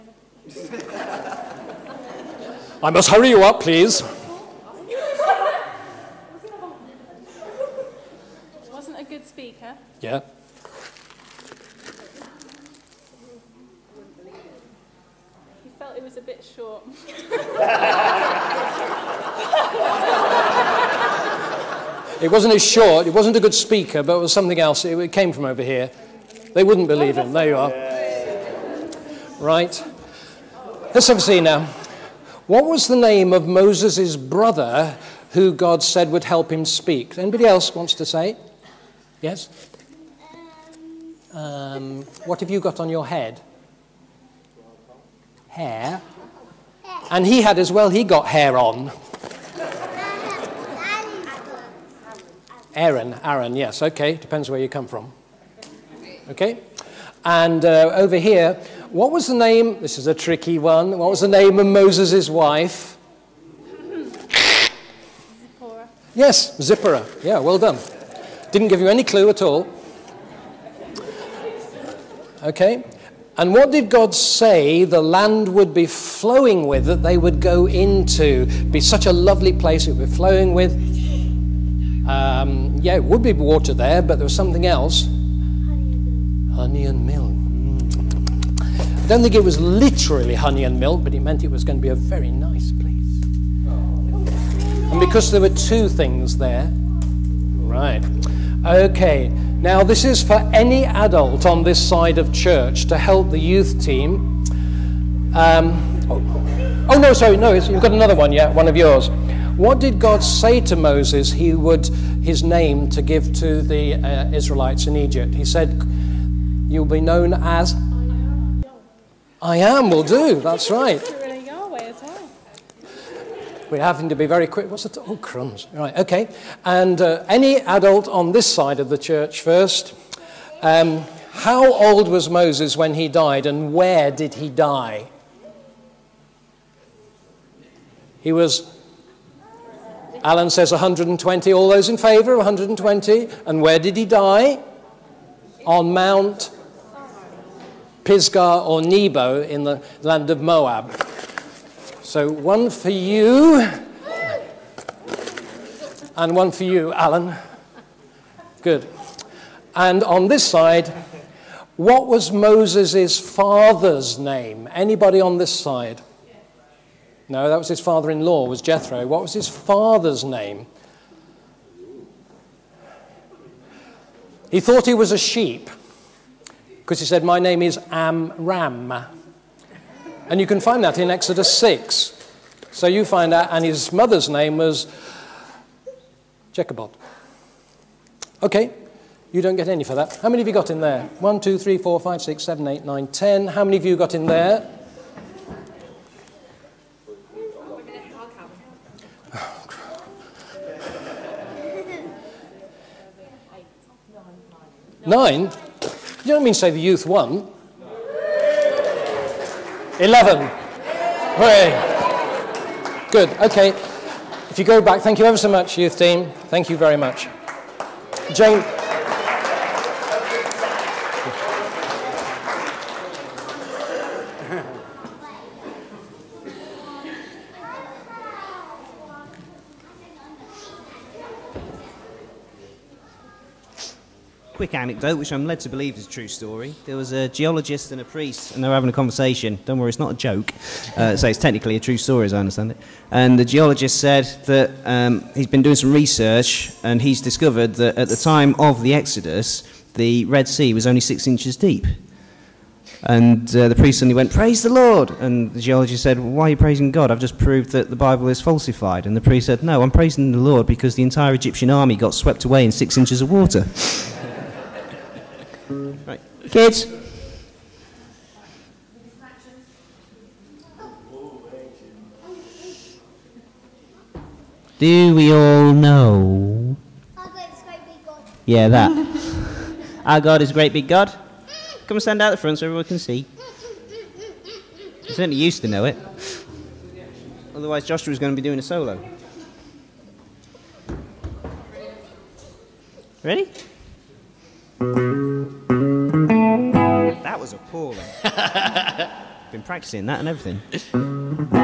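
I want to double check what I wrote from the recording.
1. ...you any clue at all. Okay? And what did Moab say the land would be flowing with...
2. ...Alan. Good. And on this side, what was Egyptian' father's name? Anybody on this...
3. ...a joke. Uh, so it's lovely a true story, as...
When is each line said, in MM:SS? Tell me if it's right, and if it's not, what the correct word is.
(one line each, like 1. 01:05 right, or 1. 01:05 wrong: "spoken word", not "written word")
1. 01:08 wrong: "God", not "Moab"
2. 02:36 wrong: "Moses", not "Egyptian"
3. 04:00 wrong: "technically", not "lovely".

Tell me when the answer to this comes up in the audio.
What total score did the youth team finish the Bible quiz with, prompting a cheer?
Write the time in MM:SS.
03:29.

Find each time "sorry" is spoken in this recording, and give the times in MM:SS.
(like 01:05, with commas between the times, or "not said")
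01:47.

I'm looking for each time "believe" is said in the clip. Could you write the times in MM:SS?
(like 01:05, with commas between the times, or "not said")
00:26, 03:55.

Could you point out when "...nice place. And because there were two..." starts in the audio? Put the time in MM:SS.
01:32.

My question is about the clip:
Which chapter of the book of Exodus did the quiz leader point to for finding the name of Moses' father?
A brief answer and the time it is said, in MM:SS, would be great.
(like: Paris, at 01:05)
Exodus 6, at 03:01.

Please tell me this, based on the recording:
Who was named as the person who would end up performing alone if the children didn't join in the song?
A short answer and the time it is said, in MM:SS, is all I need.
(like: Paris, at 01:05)
Joshua, at 04:47.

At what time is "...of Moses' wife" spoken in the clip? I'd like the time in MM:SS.
01:01.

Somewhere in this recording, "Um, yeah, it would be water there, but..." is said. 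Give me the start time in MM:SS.
01:22.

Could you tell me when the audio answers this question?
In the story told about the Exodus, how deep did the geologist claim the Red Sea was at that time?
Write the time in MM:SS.
04:11.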